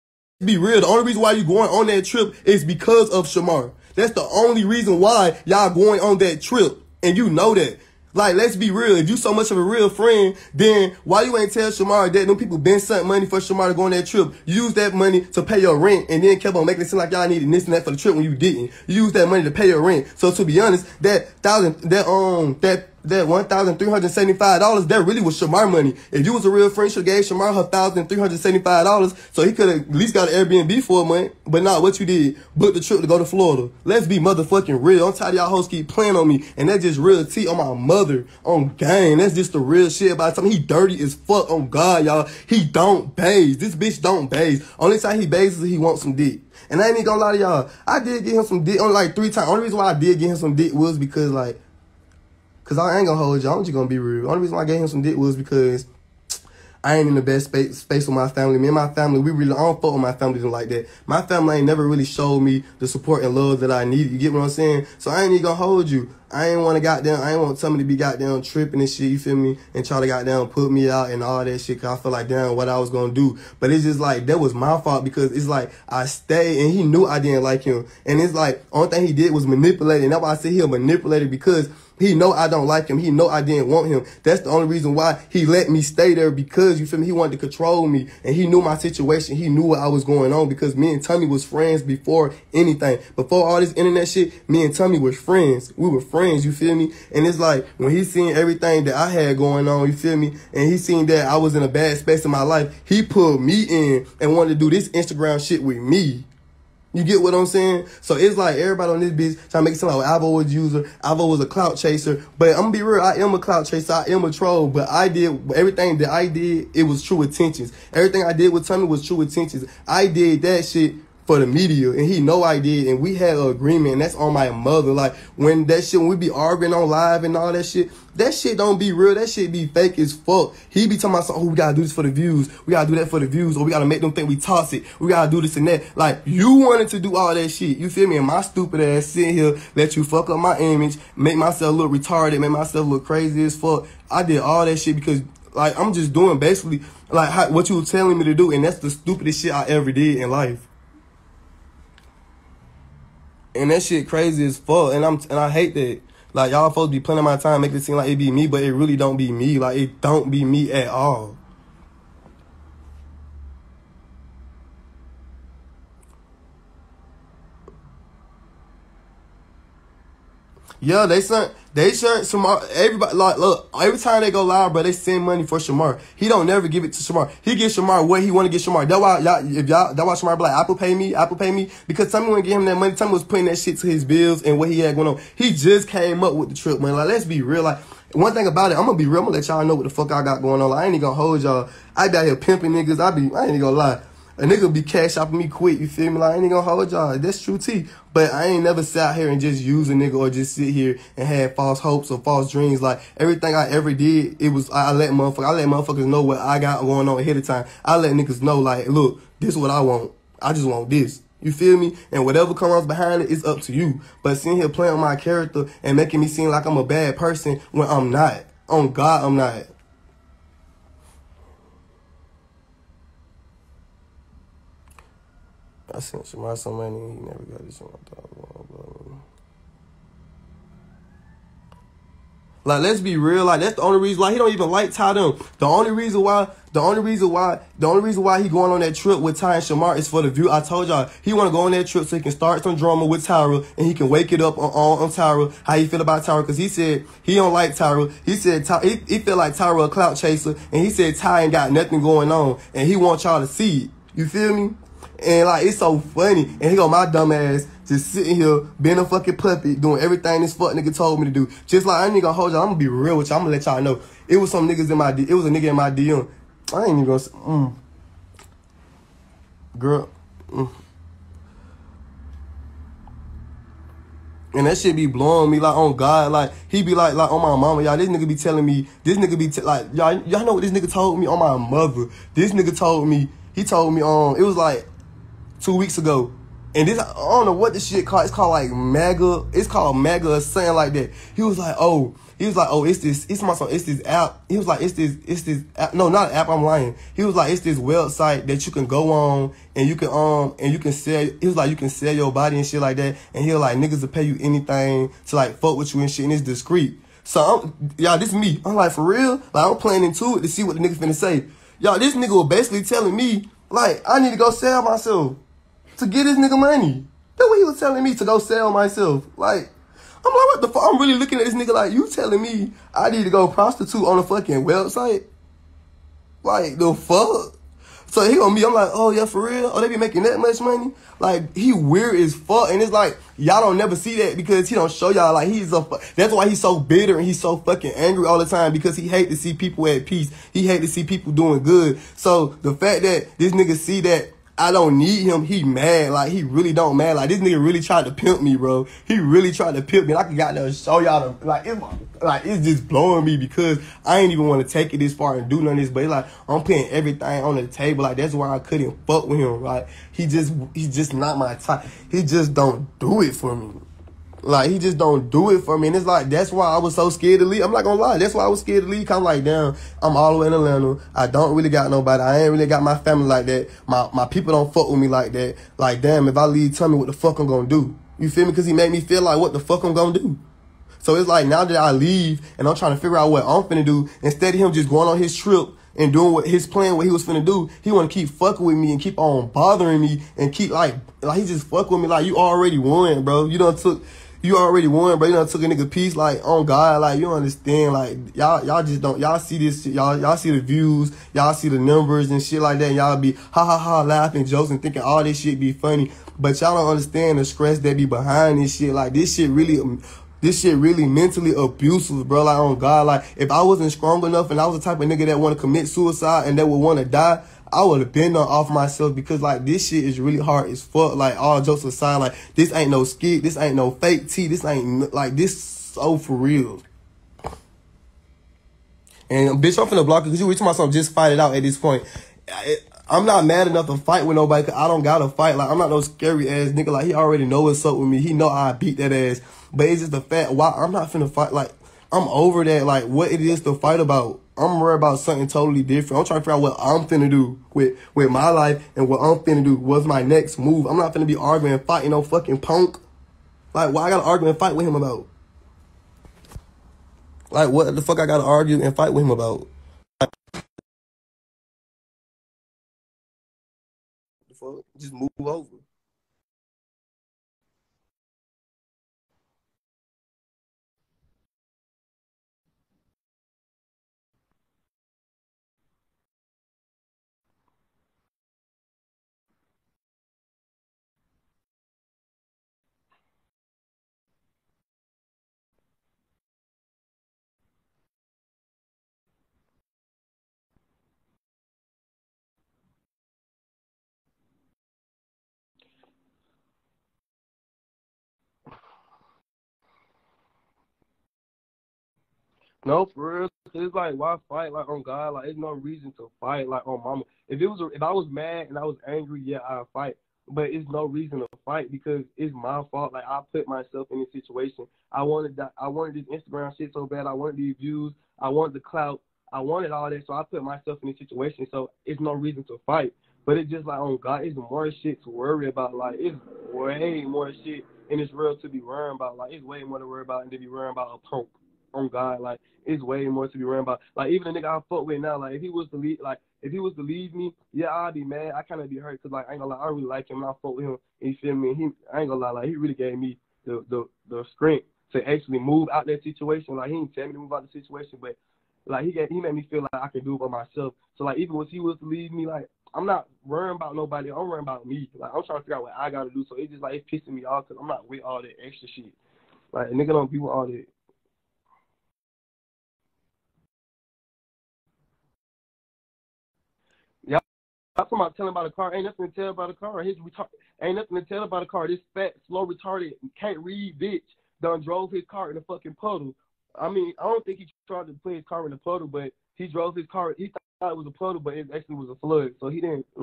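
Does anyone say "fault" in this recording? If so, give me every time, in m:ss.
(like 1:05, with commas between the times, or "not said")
1:14, 8:32.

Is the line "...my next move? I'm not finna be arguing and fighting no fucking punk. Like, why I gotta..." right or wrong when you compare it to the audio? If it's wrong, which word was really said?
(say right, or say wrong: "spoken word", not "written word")
right.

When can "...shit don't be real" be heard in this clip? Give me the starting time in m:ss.
2:08.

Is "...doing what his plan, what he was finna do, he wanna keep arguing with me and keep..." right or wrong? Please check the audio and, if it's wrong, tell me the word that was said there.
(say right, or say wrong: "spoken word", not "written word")
wrong: "fucking", not "arguing".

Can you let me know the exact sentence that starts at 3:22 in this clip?
Like, everything I ever did, it was, I let motherfuckers, I let motherfuckers know what I got going on ahead of time.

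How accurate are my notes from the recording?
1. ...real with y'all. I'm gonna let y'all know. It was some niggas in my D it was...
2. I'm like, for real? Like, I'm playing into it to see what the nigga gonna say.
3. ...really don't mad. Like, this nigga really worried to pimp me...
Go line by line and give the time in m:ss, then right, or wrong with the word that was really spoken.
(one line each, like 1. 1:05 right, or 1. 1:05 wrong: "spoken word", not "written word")
1. 4:22 right
2. 5:08 wrong: "finna", not "gonna"
3. 5:46 wrong: "tried", not "worried".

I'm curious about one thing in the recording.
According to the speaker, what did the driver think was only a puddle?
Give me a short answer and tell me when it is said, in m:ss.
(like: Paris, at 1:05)
a flood, at 9:42.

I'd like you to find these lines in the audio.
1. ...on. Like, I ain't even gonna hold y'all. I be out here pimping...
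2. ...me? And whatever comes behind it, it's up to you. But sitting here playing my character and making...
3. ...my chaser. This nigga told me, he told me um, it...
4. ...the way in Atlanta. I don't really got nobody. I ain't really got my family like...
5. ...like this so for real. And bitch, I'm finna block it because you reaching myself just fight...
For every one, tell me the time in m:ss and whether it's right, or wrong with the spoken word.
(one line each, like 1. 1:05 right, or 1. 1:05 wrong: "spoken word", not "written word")
1. 3:10 right
2. 3:31 right
3. 4:41 wrong: "mother", not "chaser"
4. 6:10 right
5. 7:05 right.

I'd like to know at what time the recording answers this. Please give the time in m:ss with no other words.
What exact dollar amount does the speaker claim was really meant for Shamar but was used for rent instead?
0:23.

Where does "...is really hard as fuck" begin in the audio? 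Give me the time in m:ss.
7:00.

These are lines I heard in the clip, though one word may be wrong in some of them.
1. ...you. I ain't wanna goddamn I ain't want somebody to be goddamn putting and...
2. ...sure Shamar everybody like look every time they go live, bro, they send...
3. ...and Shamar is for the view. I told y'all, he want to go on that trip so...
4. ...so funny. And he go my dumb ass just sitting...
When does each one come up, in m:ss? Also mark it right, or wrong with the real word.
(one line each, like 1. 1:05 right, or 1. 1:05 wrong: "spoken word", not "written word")
1. 1:05 wrong: "tripping", not "putting"
2. 2:51 right
3. 3:59 right
4. 4:15 right.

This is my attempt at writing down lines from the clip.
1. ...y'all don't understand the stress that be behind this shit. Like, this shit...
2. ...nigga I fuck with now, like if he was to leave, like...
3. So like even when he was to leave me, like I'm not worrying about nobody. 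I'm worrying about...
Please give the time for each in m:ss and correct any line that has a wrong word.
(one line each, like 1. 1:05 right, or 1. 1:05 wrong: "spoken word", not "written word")
1. 6:46 right
2. 8:54 right
3. 9:11 right.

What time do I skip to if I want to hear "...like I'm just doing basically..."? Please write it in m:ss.
2:25.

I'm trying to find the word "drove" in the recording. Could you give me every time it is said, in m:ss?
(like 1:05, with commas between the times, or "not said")
9:34, 9:39.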